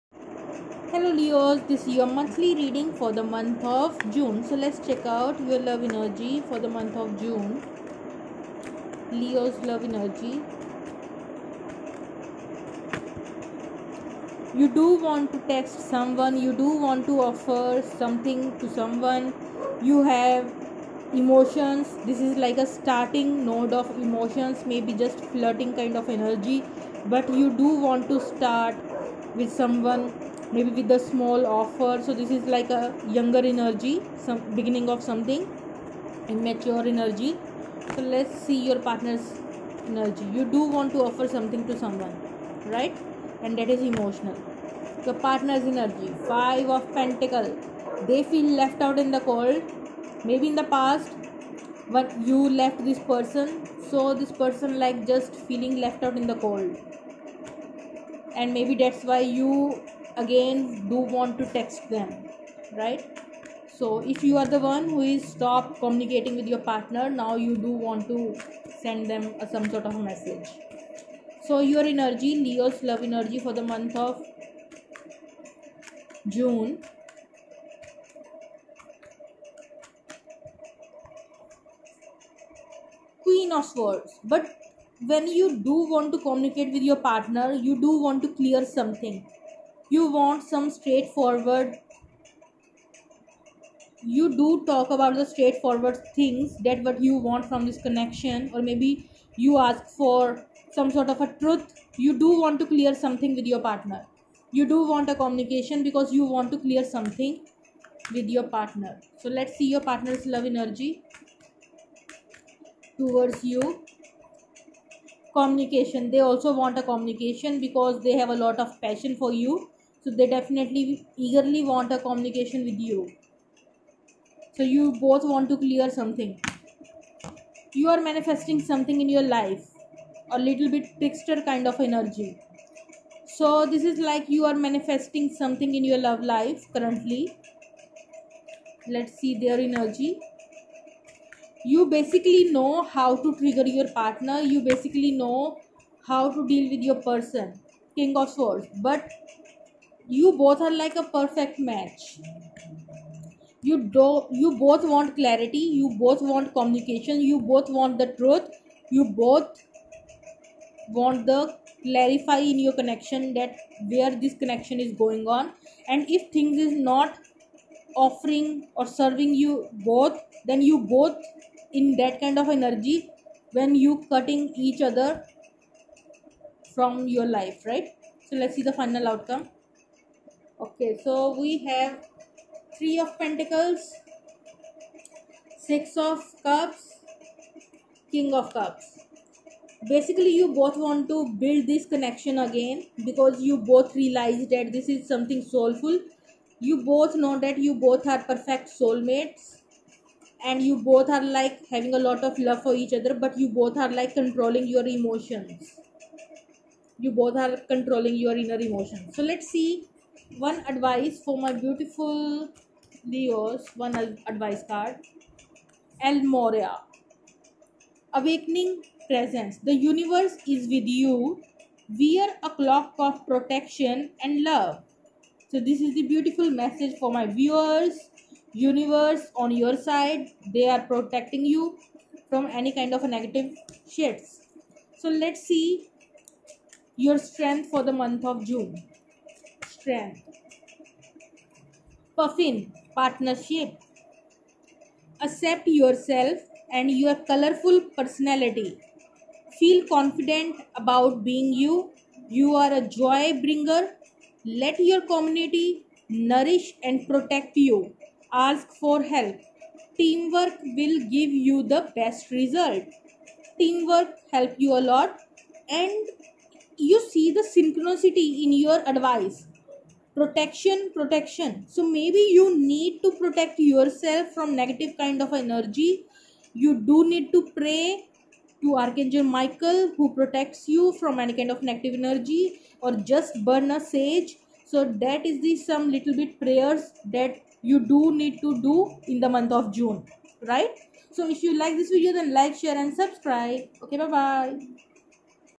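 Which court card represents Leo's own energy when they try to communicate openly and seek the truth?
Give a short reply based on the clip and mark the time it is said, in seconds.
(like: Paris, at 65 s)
Queen of Swords, at 83 s.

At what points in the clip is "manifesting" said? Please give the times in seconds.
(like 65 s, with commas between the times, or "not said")
128 s, 134 s.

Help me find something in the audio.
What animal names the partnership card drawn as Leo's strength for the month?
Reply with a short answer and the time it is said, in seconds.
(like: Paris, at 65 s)
Puffin, at 242 s.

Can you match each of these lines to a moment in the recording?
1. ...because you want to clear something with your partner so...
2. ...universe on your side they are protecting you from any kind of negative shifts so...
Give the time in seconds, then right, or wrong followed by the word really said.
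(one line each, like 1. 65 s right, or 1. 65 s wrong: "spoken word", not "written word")
1. 105 s right
2. 228 s right.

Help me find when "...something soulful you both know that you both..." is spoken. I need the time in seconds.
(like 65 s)
195 s.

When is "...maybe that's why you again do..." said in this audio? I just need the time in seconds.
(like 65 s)
58 s.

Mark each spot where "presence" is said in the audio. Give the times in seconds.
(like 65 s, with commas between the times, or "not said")
219 s.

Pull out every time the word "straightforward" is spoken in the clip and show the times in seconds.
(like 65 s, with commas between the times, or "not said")
90 s, 95 s.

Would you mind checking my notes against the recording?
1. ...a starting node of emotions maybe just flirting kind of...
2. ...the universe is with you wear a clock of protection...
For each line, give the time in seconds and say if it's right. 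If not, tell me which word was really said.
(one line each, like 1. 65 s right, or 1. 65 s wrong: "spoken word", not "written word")
1. 22 s right
2. 219 s right.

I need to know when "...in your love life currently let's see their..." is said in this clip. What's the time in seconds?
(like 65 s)
135 s.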